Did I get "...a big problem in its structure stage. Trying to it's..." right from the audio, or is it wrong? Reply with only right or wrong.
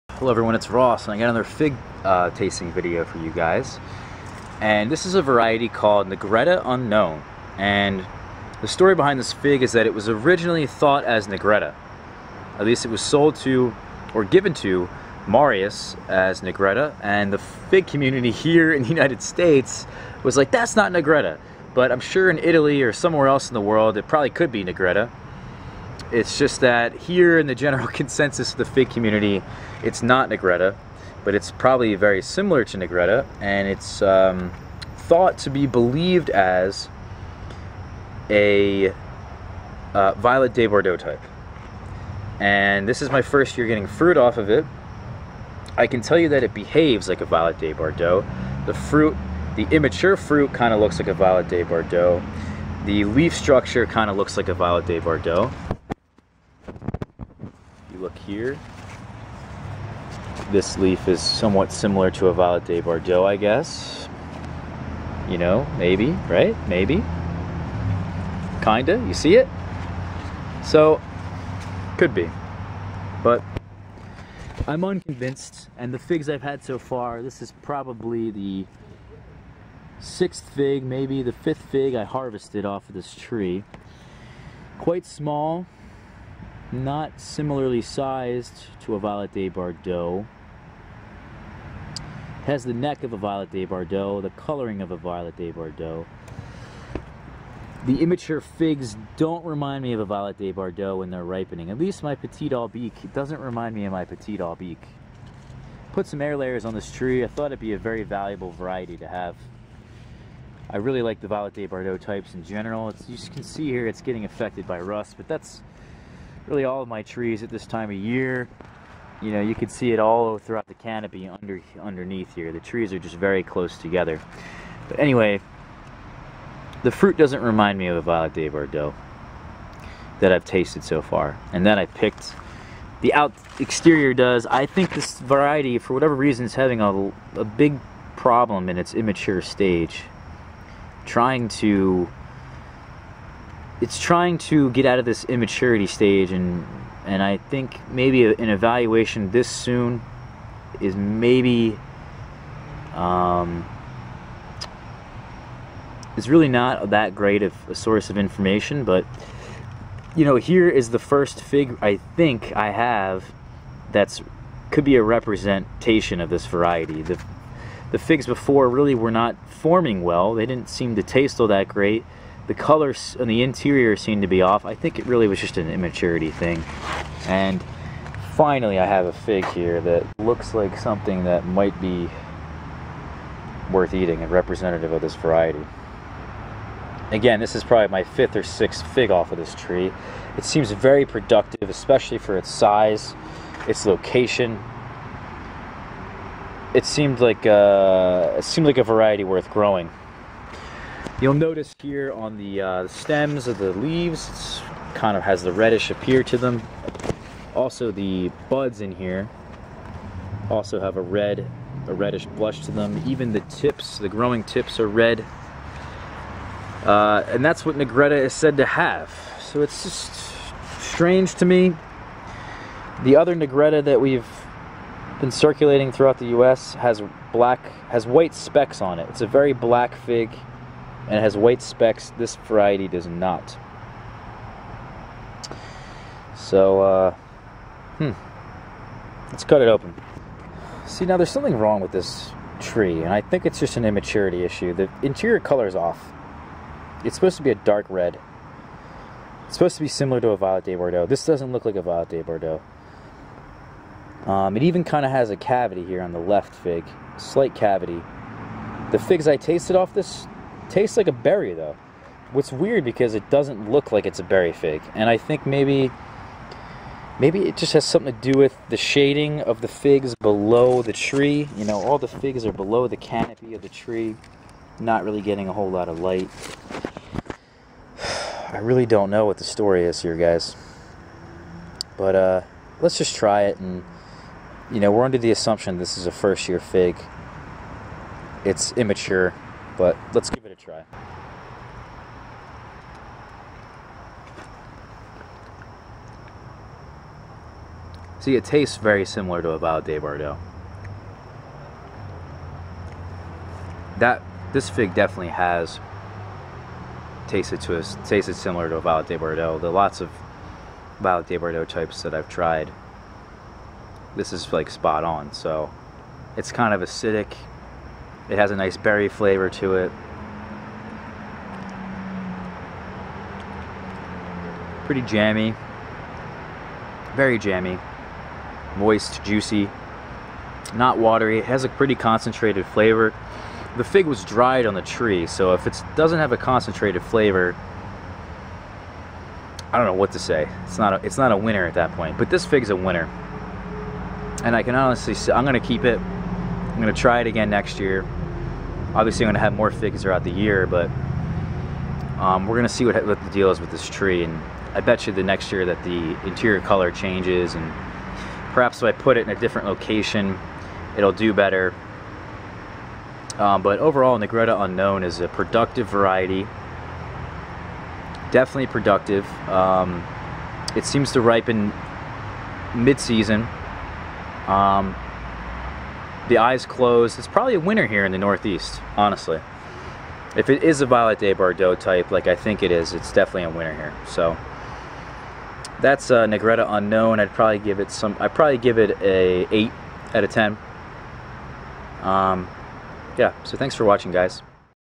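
wrong.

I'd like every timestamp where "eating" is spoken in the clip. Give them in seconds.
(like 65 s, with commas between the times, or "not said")
183 s.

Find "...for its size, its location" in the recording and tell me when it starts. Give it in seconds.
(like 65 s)
192 s.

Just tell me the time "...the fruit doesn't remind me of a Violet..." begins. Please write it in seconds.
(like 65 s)
126 s.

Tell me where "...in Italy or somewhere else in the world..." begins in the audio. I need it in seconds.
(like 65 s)
22 s.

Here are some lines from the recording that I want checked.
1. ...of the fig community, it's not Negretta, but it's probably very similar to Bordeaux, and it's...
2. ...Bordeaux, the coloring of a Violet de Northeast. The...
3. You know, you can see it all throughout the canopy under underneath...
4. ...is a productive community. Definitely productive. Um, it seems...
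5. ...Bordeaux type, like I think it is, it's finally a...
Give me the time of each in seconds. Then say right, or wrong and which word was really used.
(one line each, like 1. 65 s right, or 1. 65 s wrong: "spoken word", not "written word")
1. 28 s wrong: "Negretta", not "Bordeaux"
2. 93 s wrong: "Bordeaux", not "Northeast"
3. 119 s right
4. 365 s wrong: "variety", not "community"
5. 381 s wrong: "definitely", not "finally".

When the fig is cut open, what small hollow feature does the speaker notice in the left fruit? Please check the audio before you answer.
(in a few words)
Slight cavity.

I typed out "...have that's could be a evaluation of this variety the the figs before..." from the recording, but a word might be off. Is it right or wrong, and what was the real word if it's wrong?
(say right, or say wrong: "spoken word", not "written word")
wrong: "representation", not "evaluation".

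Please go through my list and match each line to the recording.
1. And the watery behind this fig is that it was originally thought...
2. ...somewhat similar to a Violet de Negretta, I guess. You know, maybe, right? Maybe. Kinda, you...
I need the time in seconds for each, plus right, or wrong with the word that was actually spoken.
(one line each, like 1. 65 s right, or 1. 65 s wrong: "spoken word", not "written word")
1. 7 s wrong: "story", not "watery"
2. 61 s wrong: "Bordeaux", not "Negretta".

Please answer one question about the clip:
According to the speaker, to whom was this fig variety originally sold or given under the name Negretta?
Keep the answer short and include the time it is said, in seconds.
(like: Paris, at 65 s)
Marius, at 15 s.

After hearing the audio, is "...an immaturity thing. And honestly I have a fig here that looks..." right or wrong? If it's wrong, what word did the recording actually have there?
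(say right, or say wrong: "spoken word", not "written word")
wrong: "finally", not "honestly".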